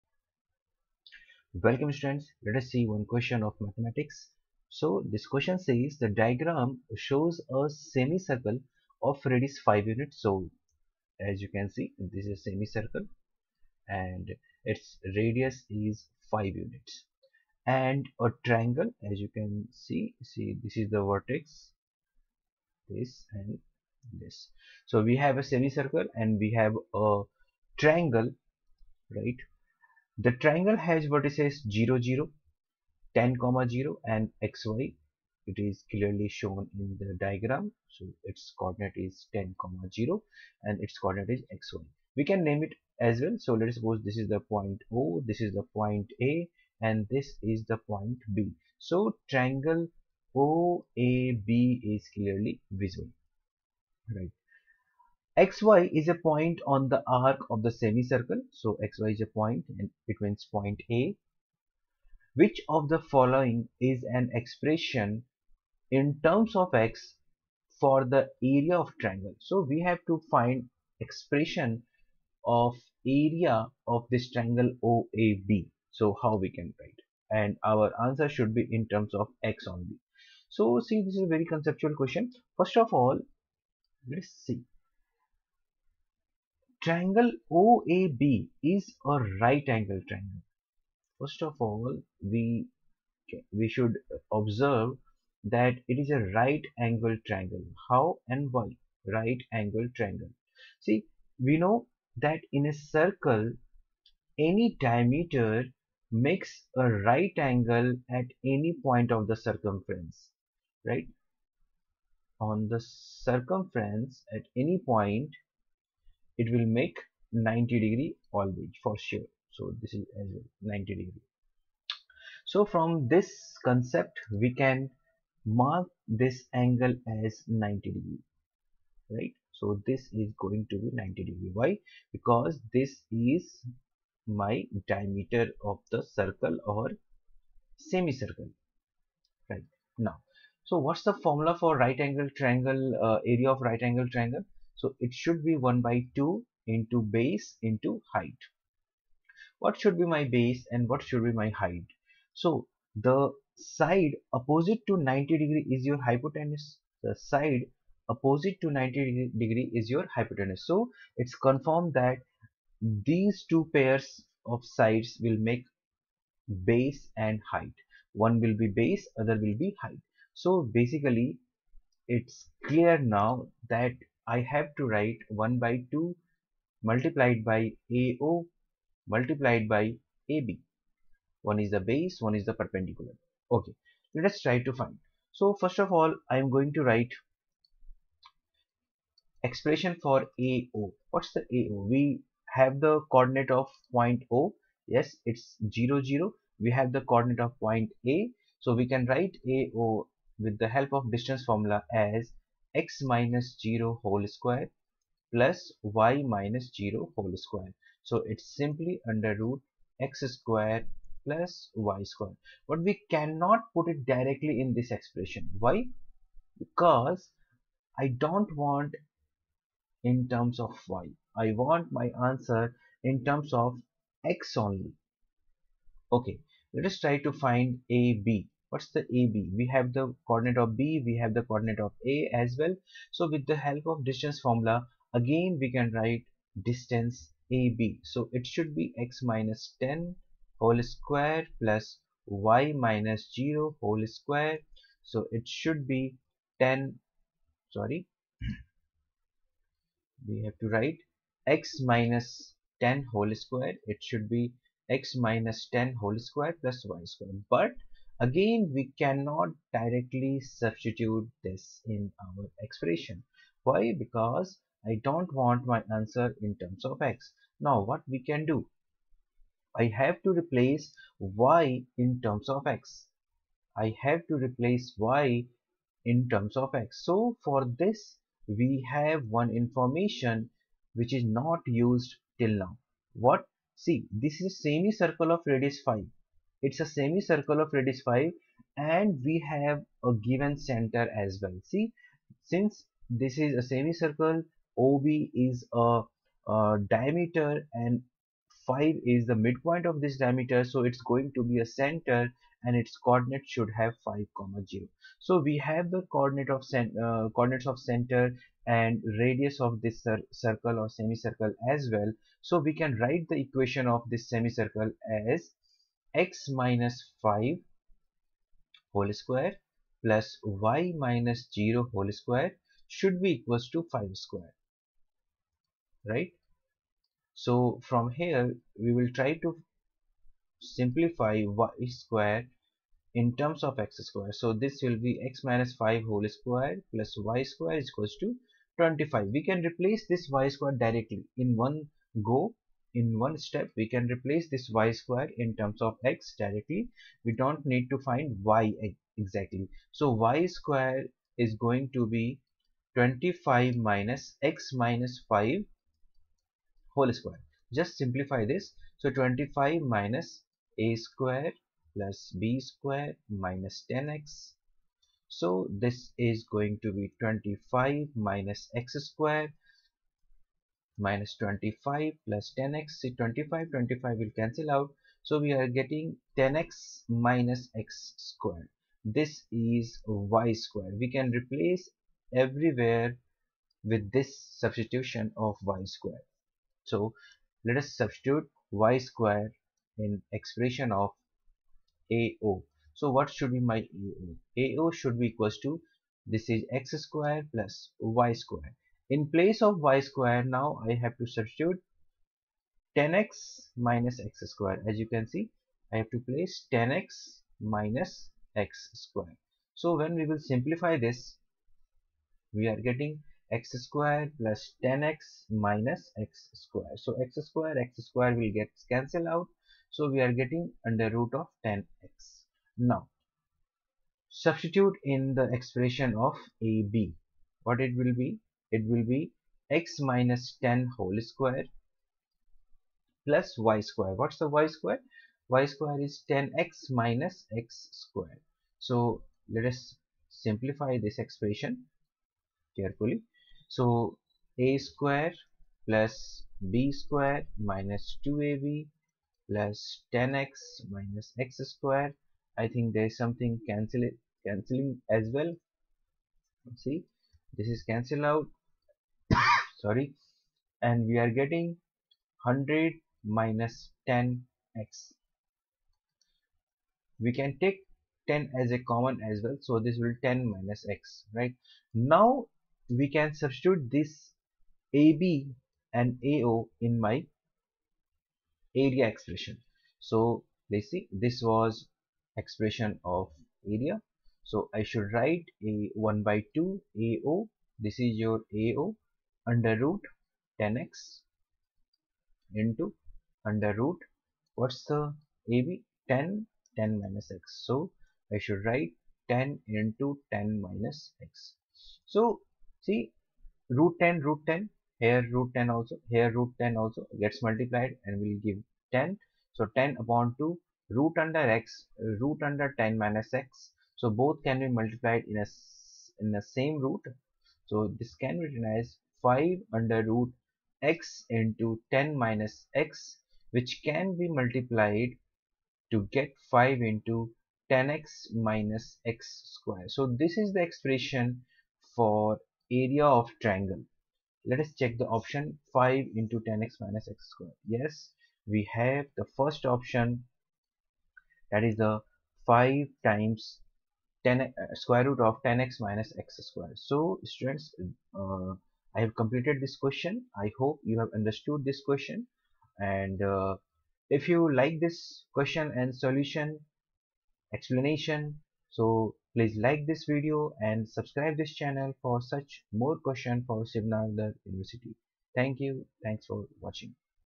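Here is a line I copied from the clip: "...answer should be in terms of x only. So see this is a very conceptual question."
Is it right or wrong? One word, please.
right.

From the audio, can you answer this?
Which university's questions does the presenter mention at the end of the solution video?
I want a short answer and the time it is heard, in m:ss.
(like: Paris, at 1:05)
Shiv Nadar University, at 9:23.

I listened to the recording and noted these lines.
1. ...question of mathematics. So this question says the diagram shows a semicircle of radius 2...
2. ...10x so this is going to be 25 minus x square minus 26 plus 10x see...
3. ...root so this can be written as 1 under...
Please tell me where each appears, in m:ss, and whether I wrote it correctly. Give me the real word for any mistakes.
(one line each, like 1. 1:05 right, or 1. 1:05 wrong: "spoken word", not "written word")
1. 0:03 wrong: "5", not "2"
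2. 6:03 wrong: "25", not "26"
3. 8:36 wrong: "5", not "1".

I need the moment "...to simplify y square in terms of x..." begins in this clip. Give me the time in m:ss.
5:29.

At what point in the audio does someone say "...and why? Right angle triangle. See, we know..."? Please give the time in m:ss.
1:38.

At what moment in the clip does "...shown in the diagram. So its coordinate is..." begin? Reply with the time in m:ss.
0:36.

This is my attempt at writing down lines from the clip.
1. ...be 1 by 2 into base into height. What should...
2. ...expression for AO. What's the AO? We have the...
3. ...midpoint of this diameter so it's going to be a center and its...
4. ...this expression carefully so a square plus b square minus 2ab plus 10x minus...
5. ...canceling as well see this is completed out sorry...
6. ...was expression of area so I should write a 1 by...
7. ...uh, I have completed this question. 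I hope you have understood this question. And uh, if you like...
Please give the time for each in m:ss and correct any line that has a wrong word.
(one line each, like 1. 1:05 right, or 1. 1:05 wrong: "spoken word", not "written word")
1. 2:25 right
2. 3:09 right
3. 4:59 right
4. 7:21 right
5. 7:34 wrong: "cancelled", not "completed"
6. 8:01 right
7. 9:08 right.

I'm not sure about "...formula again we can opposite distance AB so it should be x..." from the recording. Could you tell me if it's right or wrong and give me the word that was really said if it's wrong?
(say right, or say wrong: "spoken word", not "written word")
wrong: "write", not "opposite".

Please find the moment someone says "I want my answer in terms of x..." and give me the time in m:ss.
3:41.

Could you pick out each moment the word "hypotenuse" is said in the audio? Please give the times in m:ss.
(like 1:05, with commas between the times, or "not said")
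2:36, 2:40.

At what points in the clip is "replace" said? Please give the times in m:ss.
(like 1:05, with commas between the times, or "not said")
4:30, 4:34, 5:39, 5:44, 6:21.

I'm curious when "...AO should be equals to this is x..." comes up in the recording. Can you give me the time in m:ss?
6:34.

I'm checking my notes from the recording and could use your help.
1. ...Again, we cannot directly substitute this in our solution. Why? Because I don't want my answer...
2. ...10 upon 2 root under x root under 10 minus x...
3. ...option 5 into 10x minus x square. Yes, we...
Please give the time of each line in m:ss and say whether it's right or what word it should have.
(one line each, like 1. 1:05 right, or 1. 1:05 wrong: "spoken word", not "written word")
1. 4:18 wrong: "expression", not "solution"
2. 8:29 right
3. 8:55 right.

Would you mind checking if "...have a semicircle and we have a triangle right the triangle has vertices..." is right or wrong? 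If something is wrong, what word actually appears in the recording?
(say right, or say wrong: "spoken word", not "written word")
right.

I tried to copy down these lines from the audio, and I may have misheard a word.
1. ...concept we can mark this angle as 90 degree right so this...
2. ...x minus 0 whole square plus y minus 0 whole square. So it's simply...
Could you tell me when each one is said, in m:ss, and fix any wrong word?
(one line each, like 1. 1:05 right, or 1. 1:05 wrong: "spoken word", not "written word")
1. 2:03 right
2. 3:22 right.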